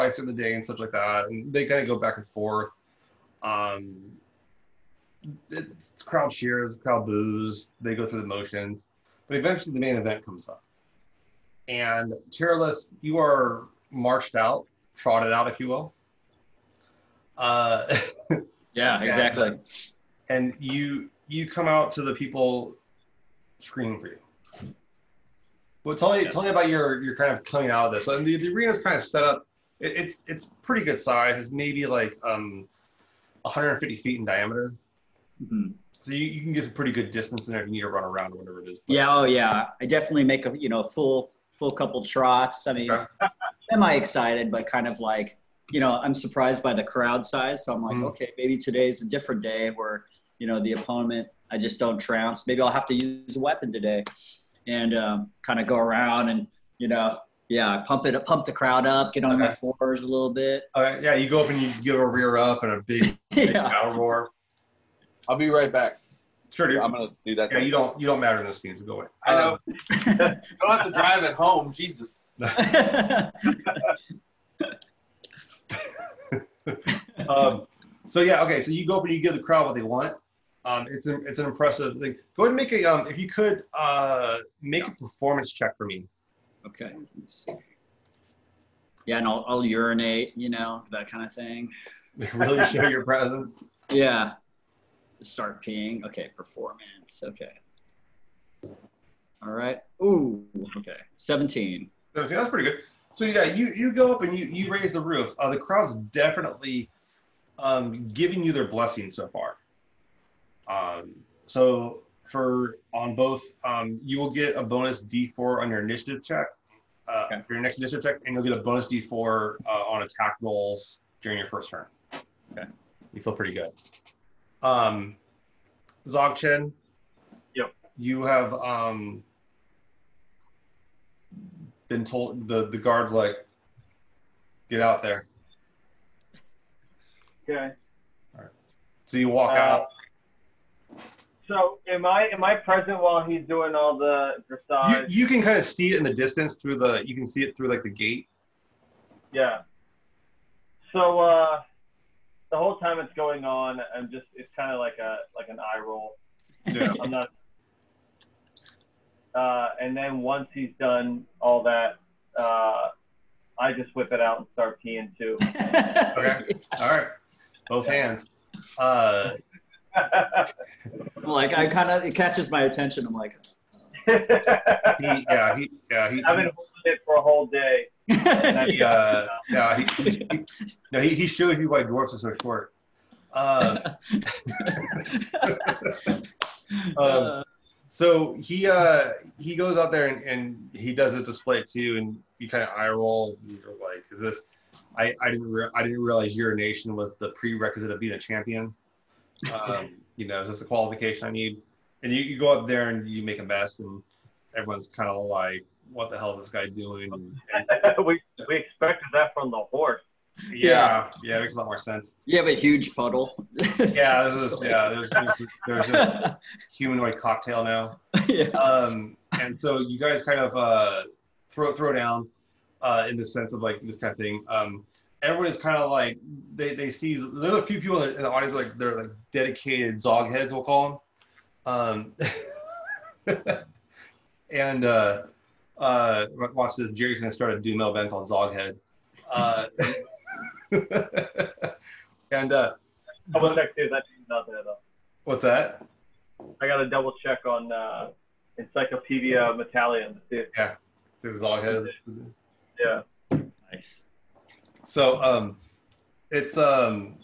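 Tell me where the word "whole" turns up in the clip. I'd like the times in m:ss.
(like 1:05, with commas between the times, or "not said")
2:32, 2:57.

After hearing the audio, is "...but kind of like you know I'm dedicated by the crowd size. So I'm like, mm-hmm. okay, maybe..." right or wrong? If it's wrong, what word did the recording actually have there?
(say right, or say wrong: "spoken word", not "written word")
wrong: "surprised", not "dedicated".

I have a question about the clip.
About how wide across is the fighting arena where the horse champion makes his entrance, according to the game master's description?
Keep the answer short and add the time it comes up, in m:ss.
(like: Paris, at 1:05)
150 feet, at 0:33.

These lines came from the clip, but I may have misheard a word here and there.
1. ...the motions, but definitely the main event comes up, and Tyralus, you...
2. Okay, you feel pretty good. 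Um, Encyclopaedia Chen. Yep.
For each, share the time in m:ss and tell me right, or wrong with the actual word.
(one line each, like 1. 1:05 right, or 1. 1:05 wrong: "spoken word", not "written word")
1. 0:08 wrong: "eventually", not "definitely"
2. 2:02 wrong: "Dzog", not "Encyclopaedia".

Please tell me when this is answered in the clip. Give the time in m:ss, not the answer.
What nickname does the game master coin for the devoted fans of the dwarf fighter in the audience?
3:49.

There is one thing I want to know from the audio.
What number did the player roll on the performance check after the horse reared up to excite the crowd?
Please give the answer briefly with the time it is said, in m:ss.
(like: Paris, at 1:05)
17, at 1:41.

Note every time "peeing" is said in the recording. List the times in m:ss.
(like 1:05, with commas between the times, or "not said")
1:35, 2:44.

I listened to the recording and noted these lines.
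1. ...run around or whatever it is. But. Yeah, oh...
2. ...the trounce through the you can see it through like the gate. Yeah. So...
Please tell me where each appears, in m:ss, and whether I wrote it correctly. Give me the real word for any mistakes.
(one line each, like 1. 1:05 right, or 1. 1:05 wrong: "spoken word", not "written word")
1. 0:37 right
2. 2:26 wrong: "distance", not "trounce".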